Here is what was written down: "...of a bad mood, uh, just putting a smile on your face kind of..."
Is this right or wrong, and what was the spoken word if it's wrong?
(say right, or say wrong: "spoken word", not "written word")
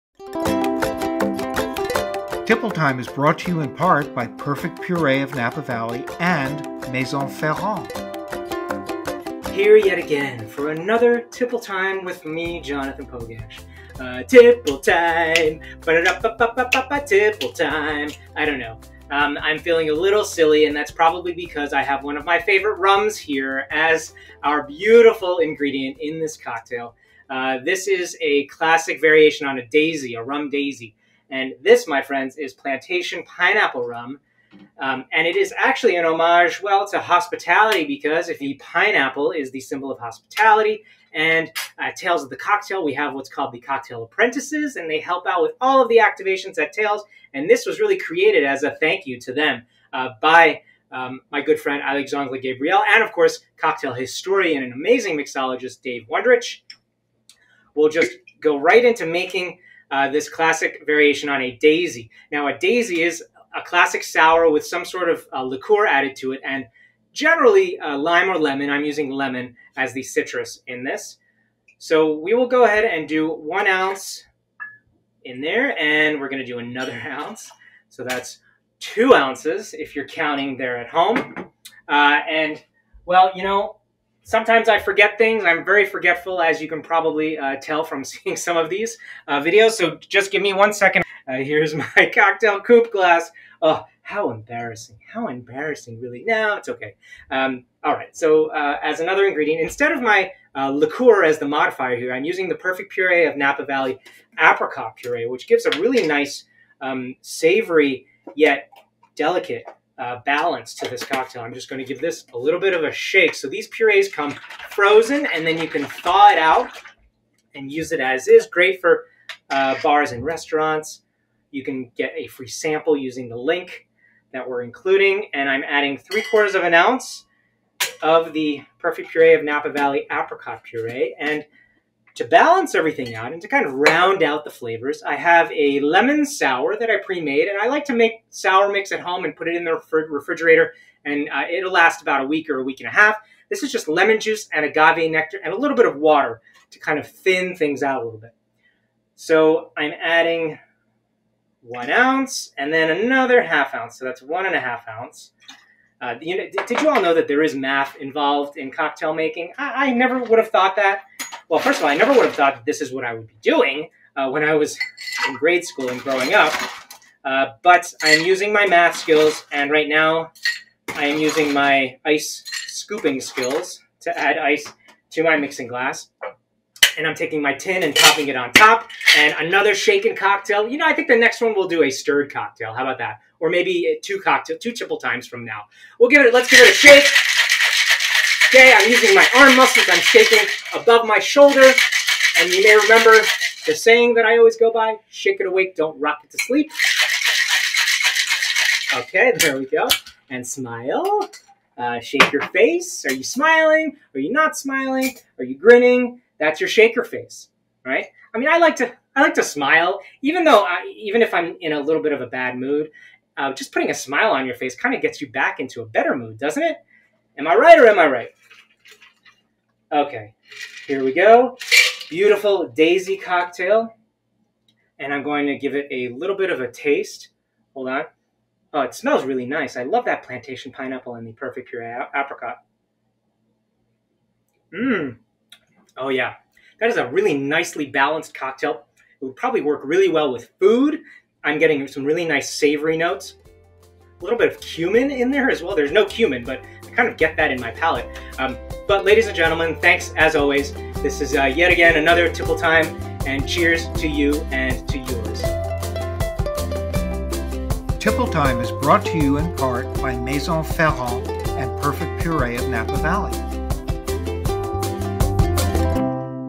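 right.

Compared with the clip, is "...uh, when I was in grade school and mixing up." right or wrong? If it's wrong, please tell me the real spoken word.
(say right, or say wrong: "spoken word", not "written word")
wrong: "growing", not "mixing".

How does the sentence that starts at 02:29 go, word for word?
So I'm adding one ounce and then another half ounce.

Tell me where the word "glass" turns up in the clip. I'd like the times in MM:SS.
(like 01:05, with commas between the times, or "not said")
01:32, 02:55.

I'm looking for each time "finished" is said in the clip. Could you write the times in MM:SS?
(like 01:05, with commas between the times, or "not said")
not said.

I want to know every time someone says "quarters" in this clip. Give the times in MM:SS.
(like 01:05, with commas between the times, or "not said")
02:06.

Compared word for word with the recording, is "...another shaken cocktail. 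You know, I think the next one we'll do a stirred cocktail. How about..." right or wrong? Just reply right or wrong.
right.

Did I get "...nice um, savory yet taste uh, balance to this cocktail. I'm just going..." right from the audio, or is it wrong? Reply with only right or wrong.
wrong.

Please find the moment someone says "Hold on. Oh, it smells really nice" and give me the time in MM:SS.
03:47.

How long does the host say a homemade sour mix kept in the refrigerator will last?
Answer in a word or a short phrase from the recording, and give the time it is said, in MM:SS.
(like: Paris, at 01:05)
about a week or a week and a half, at 02:22.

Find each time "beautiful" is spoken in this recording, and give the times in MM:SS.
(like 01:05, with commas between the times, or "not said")
00:24, 03:42.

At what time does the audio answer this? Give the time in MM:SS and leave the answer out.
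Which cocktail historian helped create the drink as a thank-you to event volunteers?
00:55.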